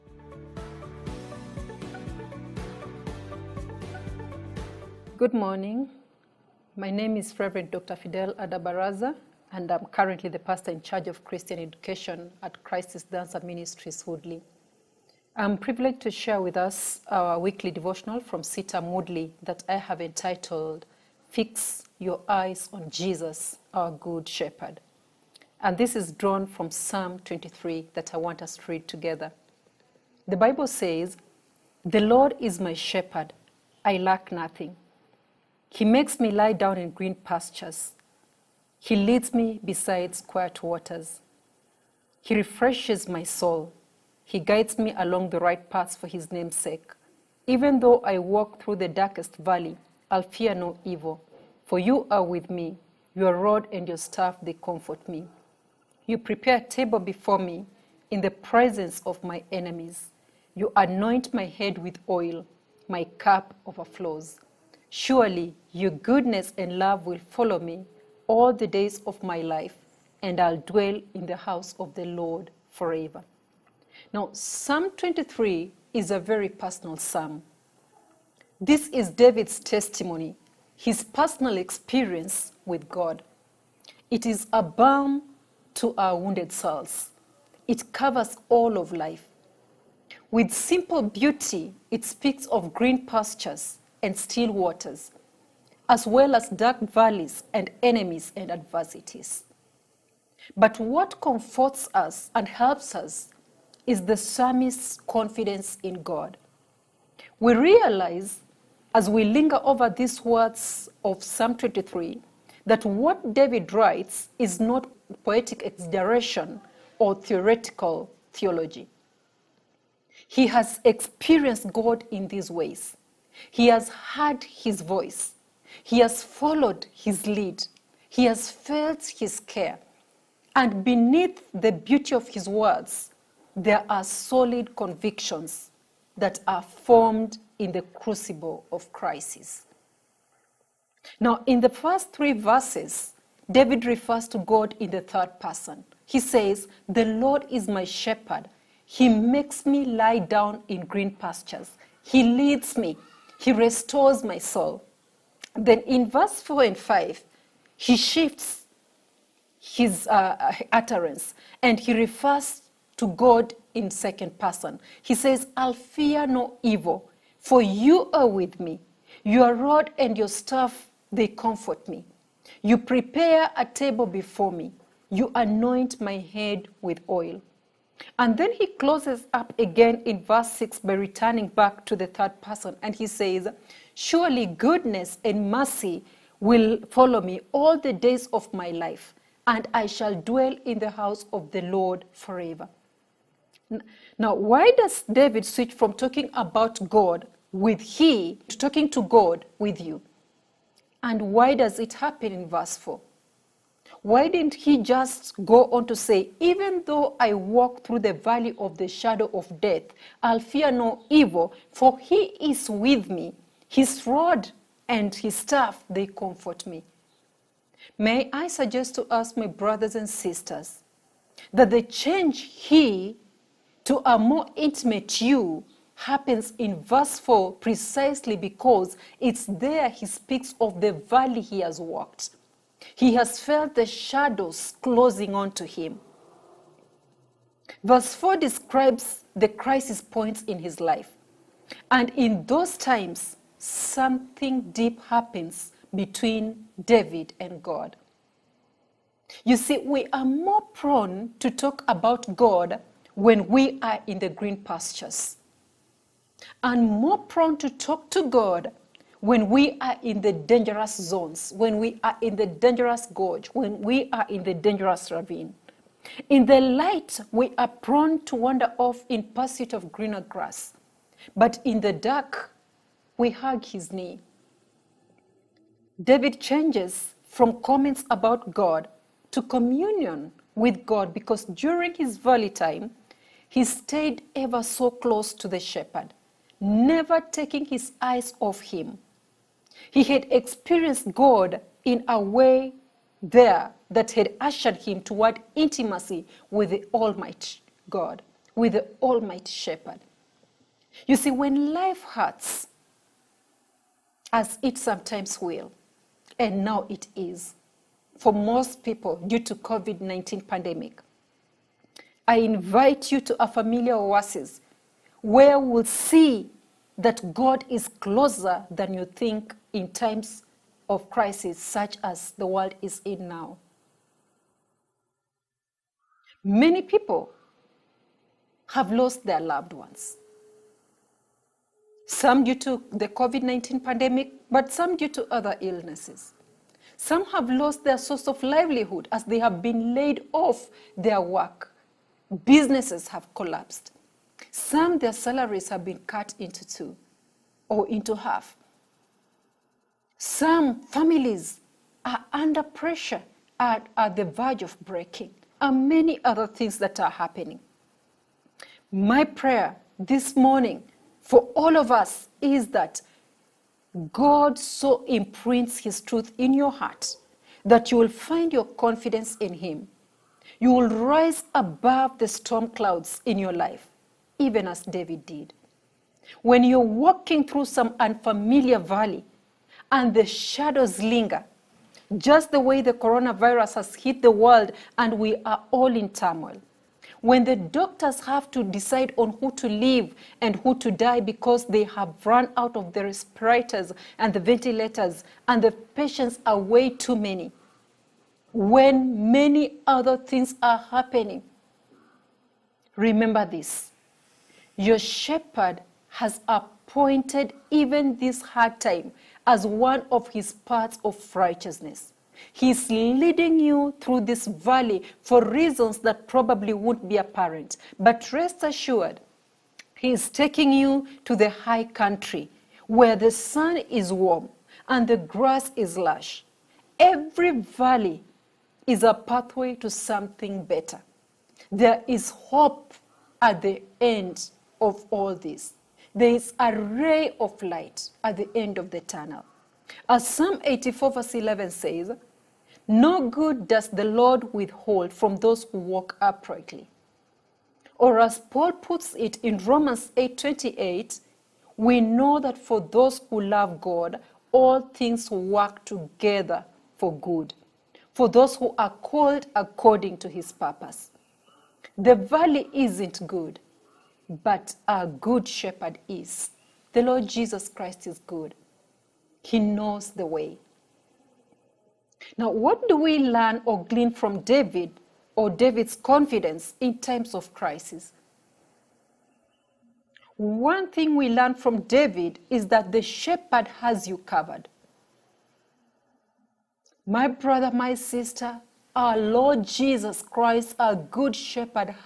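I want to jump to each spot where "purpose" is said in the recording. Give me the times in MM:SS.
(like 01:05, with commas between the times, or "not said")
07:40.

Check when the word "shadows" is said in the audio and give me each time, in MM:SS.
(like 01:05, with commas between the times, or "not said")
03:28, 03:53, 06:20.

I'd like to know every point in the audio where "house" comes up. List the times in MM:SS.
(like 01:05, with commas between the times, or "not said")
01:11, 03:10.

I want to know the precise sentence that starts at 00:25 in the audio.
And this is drawn from Psalm 23 that I want us to read together.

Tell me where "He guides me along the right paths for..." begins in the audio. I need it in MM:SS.
00:44.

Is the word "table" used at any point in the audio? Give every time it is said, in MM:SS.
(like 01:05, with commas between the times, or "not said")
00:56, 02:53.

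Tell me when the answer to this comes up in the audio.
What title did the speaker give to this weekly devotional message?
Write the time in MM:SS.
00:21.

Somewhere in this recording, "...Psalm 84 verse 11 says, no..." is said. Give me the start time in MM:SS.
07:20.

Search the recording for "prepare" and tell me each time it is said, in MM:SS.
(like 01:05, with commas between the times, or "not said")
00:56, 02:52.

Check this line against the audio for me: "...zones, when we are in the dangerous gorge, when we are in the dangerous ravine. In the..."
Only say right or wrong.
right.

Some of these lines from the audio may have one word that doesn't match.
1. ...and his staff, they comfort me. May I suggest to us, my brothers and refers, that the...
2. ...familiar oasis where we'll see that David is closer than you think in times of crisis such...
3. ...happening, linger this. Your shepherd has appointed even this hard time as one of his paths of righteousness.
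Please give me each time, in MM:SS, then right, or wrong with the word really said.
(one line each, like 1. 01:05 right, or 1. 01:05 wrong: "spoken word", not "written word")
1. 03:34 wrong: "sisters", not "refers"
2. 05:13 wrong: "God", not "David"
3. 06:40 wrong: "remember", not "linger".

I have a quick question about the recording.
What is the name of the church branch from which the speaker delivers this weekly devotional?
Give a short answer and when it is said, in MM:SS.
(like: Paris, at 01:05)
CITAM Woodley, at 00:18.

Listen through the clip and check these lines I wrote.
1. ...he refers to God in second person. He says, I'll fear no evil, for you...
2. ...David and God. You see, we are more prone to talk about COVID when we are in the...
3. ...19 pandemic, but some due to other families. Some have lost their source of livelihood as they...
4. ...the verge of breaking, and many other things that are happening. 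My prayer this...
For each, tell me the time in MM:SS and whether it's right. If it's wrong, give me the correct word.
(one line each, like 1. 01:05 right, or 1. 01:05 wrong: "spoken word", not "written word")
1. 02:41 right
2. 04:06 wrong: "God", not "COVID"
3. 05:33 wrong: "illnesses", not "families"
4. 05:54 right.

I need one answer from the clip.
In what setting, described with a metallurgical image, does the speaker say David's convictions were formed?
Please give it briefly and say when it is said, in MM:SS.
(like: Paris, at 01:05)
The crucible of crisis, at 02:17.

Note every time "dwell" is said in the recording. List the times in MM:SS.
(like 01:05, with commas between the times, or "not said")
01:10, 03:10.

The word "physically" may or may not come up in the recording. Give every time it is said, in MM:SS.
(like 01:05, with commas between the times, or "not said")
not said.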